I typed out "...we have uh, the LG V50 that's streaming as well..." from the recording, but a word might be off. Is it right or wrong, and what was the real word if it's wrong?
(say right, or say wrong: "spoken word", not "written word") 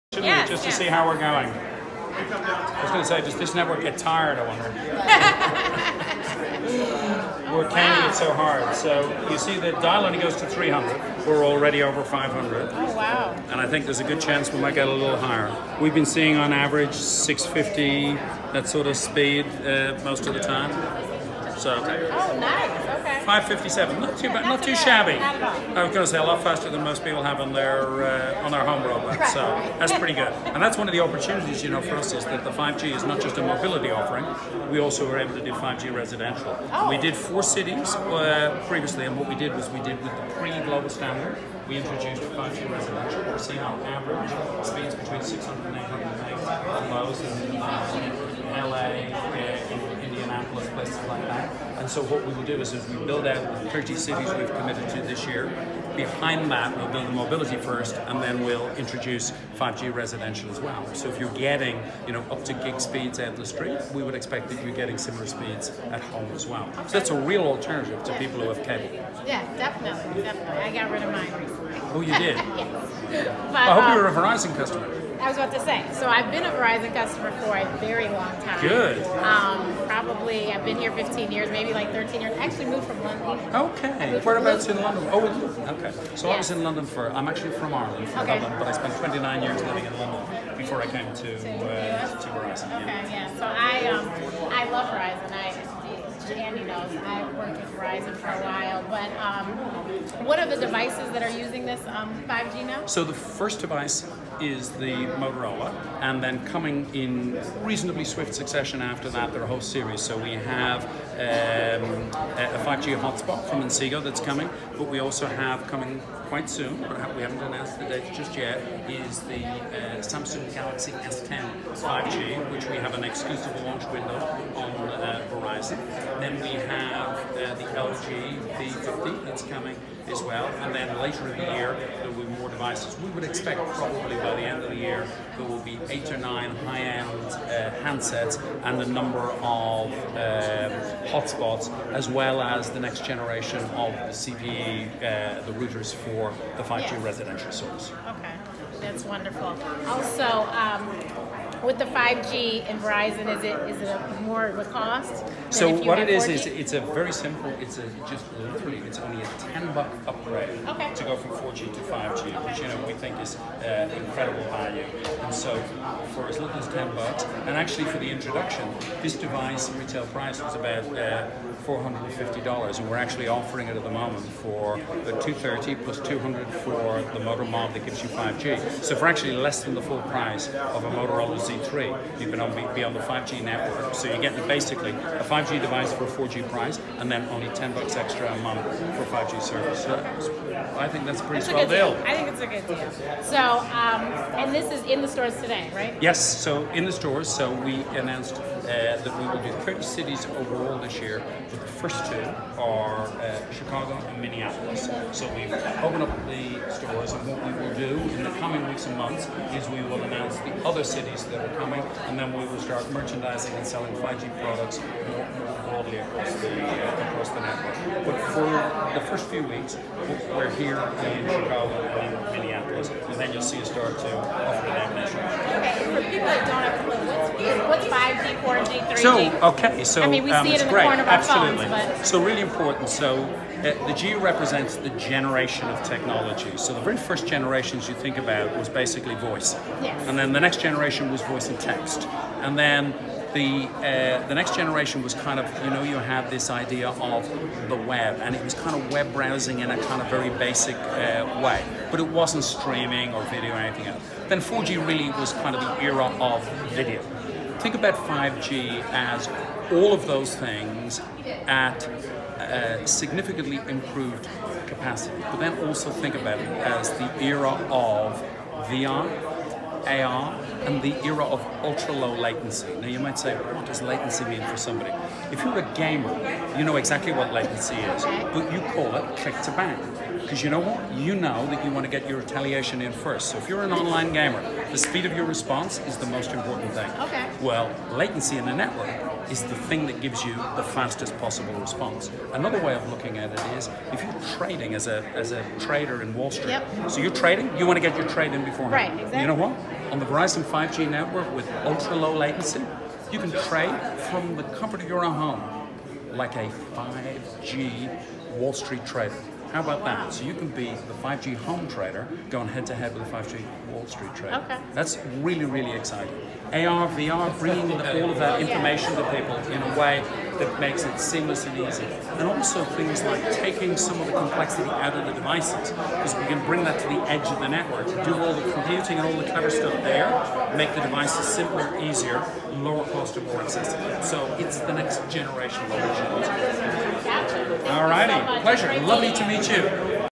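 wrong: "coming", not "streaming".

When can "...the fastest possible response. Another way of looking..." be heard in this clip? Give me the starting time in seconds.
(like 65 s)
290 s.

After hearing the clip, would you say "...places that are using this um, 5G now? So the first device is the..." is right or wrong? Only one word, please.
wrong.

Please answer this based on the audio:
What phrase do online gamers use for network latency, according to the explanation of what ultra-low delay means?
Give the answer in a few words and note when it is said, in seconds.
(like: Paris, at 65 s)
click to bang, at 279 s.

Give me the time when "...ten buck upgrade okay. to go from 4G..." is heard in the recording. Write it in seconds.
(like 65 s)
159 s.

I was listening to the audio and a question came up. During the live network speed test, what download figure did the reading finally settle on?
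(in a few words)
557.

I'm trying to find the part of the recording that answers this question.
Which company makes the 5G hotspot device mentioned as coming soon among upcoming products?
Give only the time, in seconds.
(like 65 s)
113 s.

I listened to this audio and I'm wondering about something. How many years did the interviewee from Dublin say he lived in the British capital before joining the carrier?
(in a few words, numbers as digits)
29.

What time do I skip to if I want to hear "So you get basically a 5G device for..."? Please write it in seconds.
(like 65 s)
183 s.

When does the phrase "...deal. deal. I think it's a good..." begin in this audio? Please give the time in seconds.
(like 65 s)
191 s.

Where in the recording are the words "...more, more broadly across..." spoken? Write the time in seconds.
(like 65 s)
215 s.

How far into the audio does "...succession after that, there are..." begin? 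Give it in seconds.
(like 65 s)
108 s.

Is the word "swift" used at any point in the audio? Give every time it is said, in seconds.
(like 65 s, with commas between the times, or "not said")
108 s.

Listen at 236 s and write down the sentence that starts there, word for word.
So the very first generations you think about was basically voice.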